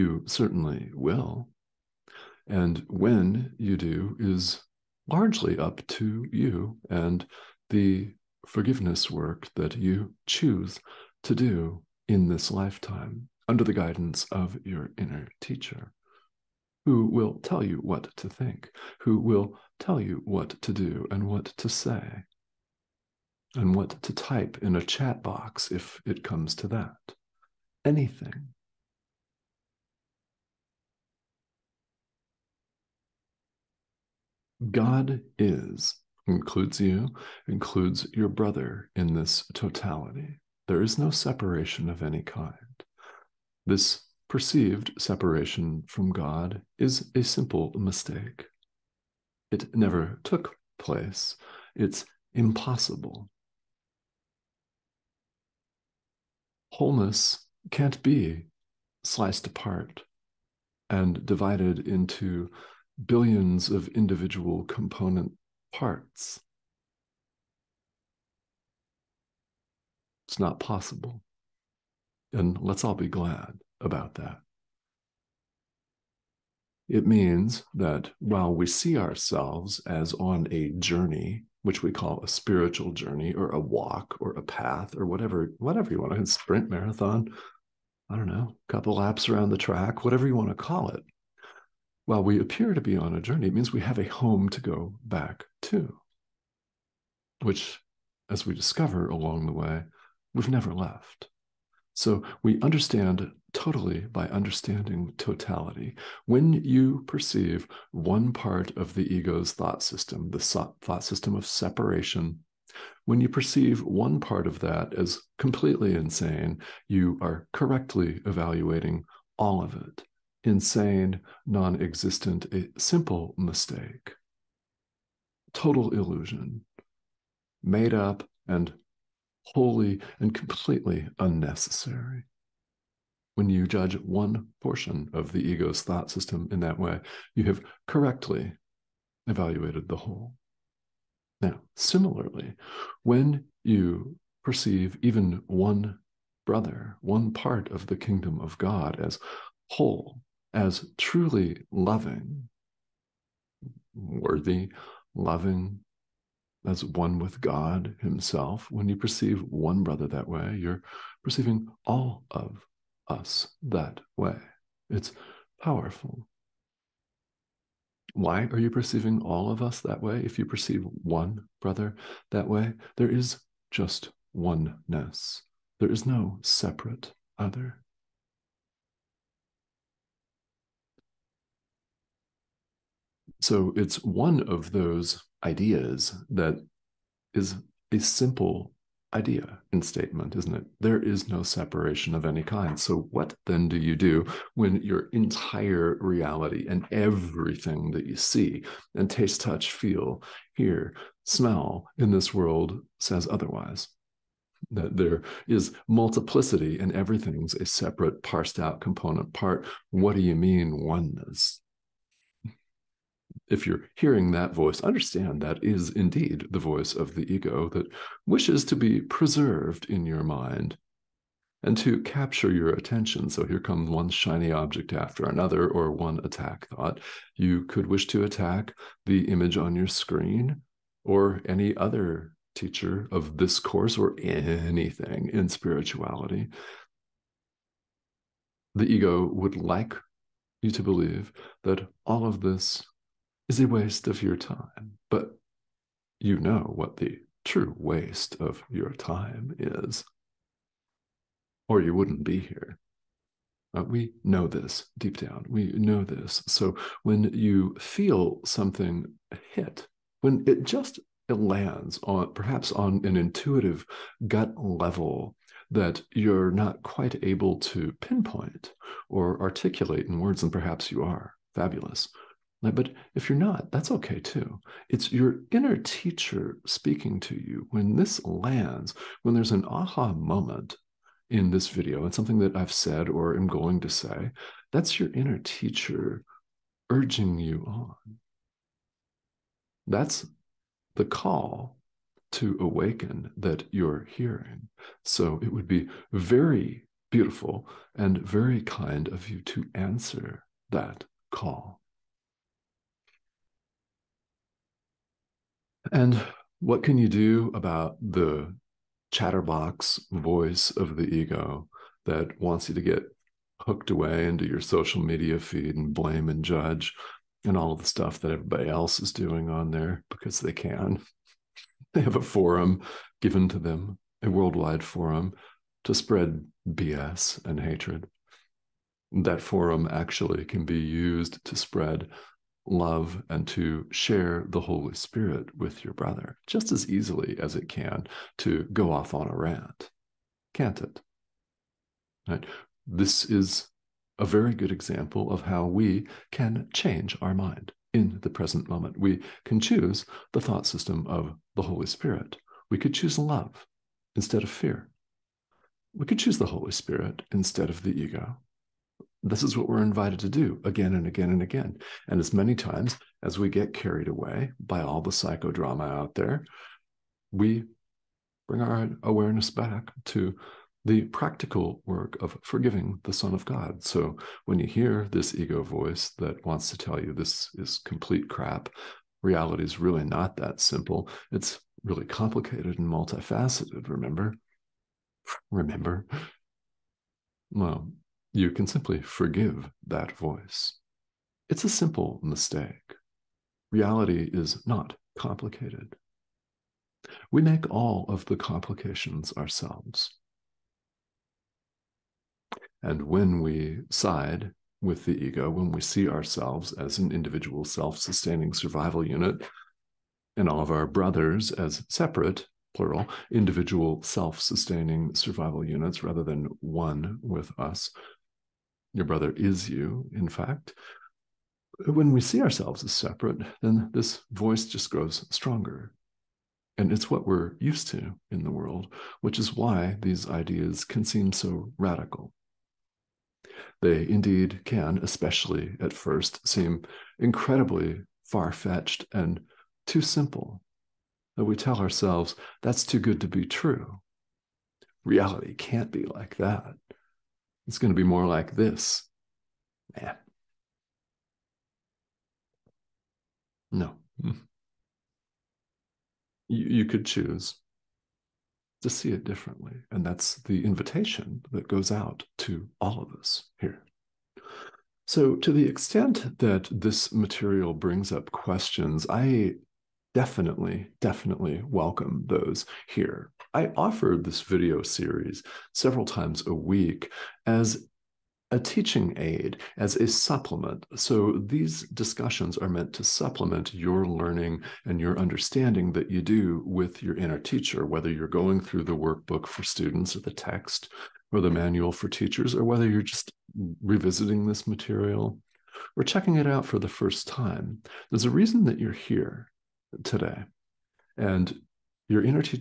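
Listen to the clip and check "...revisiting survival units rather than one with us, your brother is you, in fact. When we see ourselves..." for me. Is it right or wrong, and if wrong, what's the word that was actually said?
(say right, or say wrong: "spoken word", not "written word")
wrong: "sustaining", not "revisiting".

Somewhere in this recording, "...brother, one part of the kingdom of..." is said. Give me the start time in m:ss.
2:26.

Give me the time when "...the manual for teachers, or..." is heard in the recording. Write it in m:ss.
8:11.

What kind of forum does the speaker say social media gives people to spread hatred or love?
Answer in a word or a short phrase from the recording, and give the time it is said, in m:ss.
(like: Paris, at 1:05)
worldwide forum, at 5:24.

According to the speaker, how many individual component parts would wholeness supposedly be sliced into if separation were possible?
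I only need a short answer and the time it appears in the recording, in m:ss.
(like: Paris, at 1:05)
billions, at 1:03.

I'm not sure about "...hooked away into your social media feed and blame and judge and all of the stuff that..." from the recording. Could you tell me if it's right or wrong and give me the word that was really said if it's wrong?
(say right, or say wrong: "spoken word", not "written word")
right.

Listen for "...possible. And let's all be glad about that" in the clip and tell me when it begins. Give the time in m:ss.
1:10.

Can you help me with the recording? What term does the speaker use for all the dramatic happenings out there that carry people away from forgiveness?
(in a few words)
psychodrama.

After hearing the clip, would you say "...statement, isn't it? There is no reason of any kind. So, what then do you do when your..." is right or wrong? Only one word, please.
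wrong.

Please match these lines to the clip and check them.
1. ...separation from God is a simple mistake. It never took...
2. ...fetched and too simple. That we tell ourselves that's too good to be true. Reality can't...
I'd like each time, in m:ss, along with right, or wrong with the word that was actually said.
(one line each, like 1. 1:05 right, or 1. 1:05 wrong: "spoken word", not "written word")
1. 0:44 right
2. 7:18 right.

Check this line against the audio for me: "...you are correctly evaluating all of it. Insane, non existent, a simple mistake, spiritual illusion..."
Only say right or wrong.
wrong.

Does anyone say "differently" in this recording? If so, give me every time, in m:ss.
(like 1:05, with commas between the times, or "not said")
7:39.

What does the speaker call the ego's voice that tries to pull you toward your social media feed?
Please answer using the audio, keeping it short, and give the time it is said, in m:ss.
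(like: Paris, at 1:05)
chatterbox voice, at 5:09.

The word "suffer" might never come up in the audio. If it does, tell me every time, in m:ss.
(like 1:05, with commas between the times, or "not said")
not said.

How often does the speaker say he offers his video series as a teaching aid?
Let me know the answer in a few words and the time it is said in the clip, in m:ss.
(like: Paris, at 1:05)
several times a week, at 7:55.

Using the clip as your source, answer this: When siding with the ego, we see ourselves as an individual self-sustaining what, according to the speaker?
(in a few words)
survival unit.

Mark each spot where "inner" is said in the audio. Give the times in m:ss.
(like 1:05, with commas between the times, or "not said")
0:14, 4:35, 4:45, 8:07.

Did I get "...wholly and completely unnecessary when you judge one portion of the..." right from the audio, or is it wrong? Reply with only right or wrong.
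right.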